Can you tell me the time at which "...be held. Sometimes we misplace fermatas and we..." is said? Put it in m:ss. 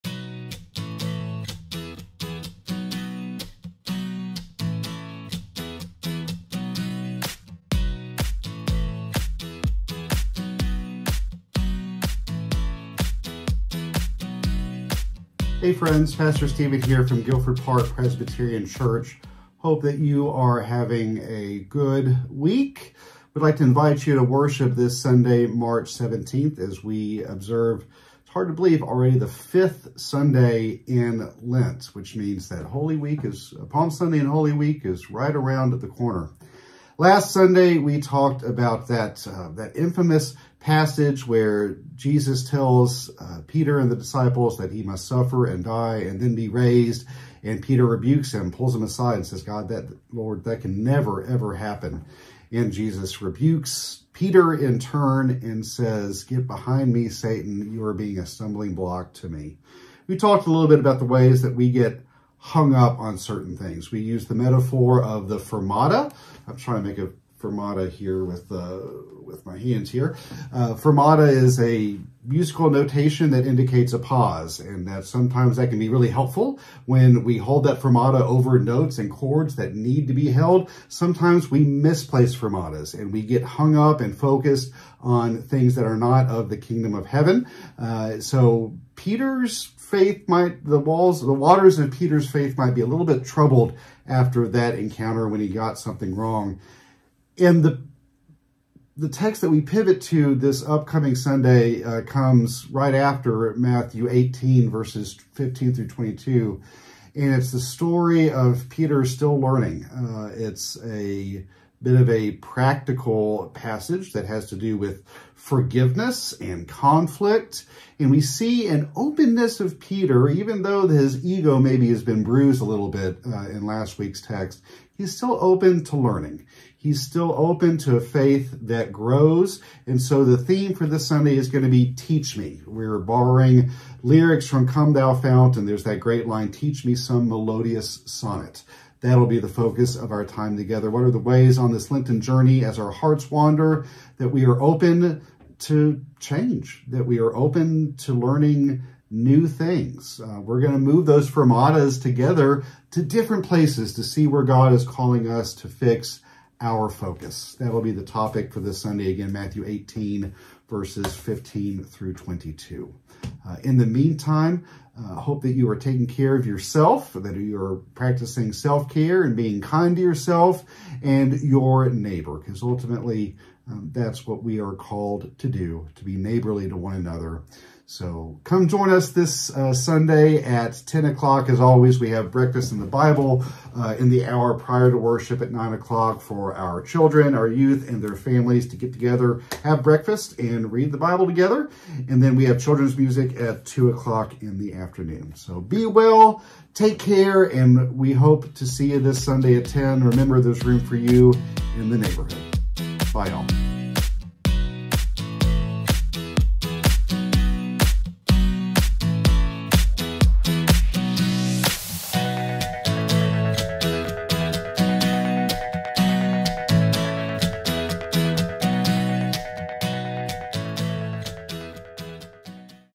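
1:20.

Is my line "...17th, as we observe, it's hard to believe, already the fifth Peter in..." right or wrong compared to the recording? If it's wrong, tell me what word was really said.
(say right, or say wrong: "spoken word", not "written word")
wrong: "Sunday", not "Peter".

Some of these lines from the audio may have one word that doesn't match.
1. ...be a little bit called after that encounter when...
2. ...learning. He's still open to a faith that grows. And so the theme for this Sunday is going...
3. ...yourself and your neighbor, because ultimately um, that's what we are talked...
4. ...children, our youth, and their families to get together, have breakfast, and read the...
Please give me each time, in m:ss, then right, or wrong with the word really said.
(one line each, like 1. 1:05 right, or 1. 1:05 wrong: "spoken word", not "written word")
1. 1:32 wrong: "troubled", not "called"
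2. 2:05 right
3. 2:50 wrong: "called", not "talked"
4. 3:06 right.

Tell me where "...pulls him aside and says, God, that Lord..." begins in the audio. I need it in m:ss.
0:48.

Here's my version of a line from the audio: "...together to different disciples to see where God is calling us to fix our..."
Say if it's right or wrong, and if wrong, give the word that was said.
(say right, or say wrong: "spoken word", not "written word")
wrong: "places", not "disciples".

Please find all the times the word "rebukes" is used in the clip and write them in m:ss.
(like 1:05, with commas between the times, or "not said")
0:47, 0:53.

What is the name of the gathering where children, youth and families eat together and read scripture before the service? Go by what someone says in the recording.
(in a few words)
Breakfast in the Bible.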